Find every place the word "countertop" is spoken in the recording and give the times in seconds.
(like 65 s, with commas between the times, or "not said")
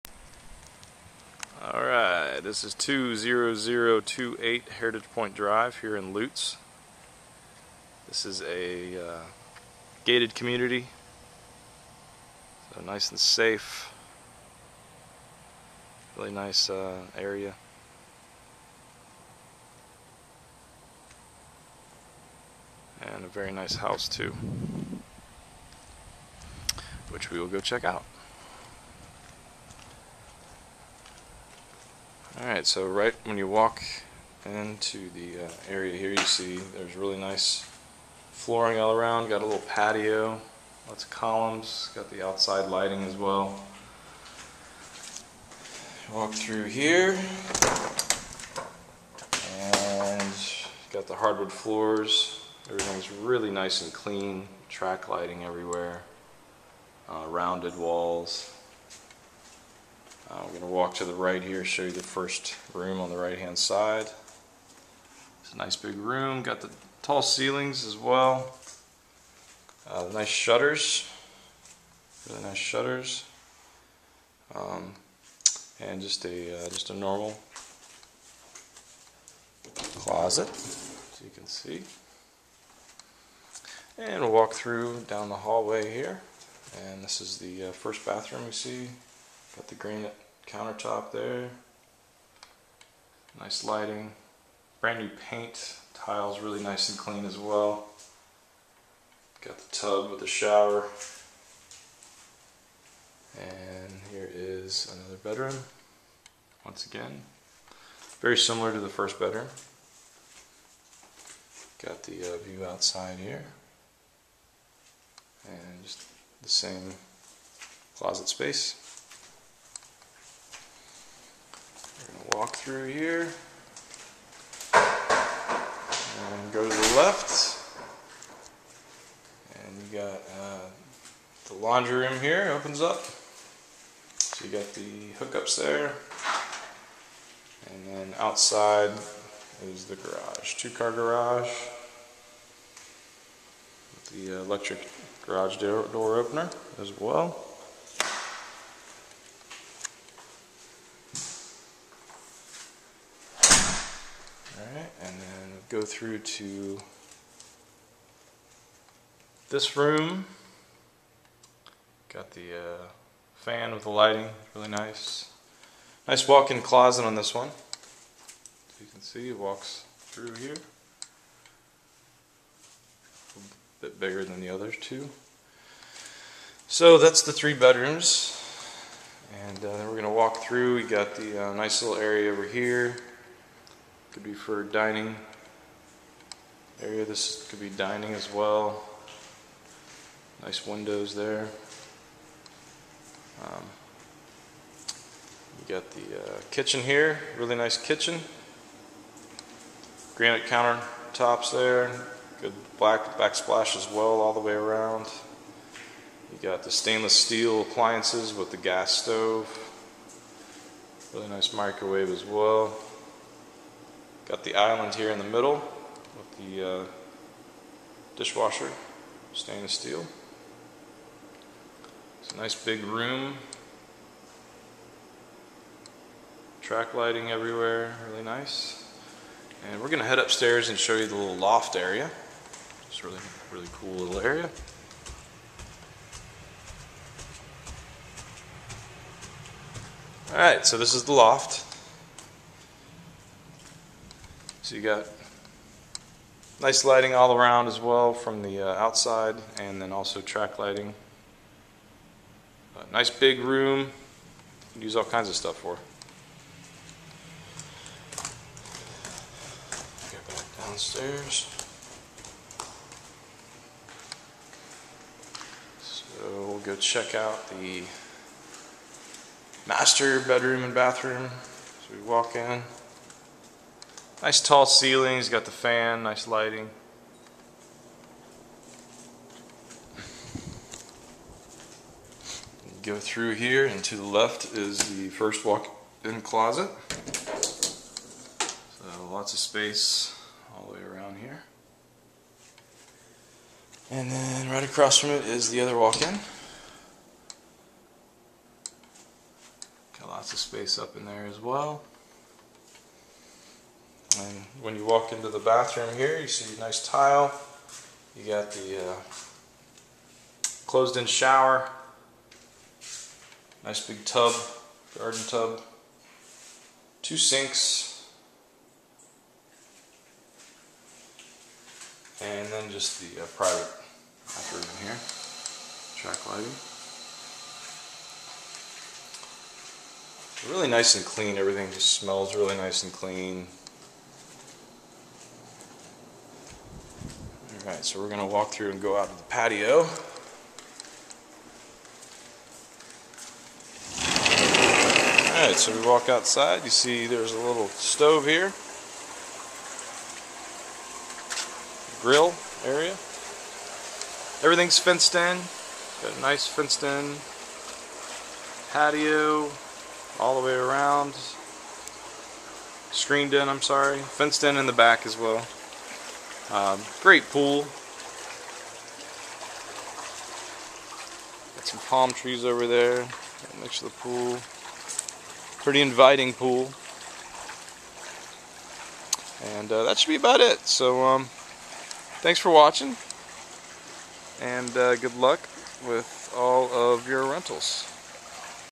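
90 s, 200 s.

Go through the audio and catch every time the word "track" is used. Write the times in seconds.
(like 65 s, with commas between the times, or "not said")
54 s, 226 s, 250 s, 325 s.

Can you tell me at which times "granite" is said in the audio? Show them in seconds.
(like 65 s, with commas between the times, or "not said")
89 s, 200 s.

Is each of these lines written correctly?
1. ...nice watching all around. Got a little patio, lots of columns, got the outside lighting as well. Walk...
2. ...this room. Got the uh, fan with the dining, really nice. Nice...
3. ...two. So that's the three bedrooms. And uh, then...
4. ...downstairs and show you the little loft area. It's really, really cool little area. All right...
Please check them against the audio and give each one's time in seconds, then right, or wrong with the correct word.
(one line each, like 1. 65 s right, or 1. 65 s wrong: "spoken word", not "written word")
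1. 37 s wrong: "flooring", not "watching"
2. 159 s wrong: "lighting", not "dining"
3. 174 s right
4. 230 s wrong: "upstairs", not "downstairs".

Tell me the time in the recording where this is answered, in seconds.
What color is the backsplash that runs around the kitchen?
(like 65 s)
202 s.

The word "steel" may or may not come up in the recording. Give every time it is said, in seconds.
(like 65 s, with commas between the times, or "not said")
207 s, 219 s.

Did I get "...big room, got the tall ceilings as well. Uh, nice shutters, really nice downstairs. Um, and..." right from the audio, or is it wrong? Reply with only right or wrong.
wrong.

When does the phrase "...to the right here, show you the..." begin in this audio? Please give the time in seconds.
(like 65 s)
60 s.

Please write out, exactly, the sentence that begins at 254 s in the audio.
Use all kinds of stuff for.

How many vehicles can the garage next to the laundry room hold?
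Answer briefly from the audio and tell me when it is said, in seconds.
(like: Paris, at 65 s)
2, at 140 s.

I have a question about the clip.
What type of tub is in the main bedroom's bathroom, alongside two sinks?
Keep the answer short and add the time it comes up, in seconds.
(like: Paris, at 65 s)
Garden tub, at 314 s.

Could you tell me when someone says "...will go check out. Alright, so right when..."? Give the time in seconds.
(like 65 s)
27 s.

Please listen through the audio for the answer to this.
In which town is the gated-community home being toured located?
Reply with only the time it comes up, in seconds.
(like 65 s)
6 s.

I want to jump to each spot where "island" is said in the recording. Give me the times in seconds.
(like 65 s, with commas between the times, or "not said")
214 s.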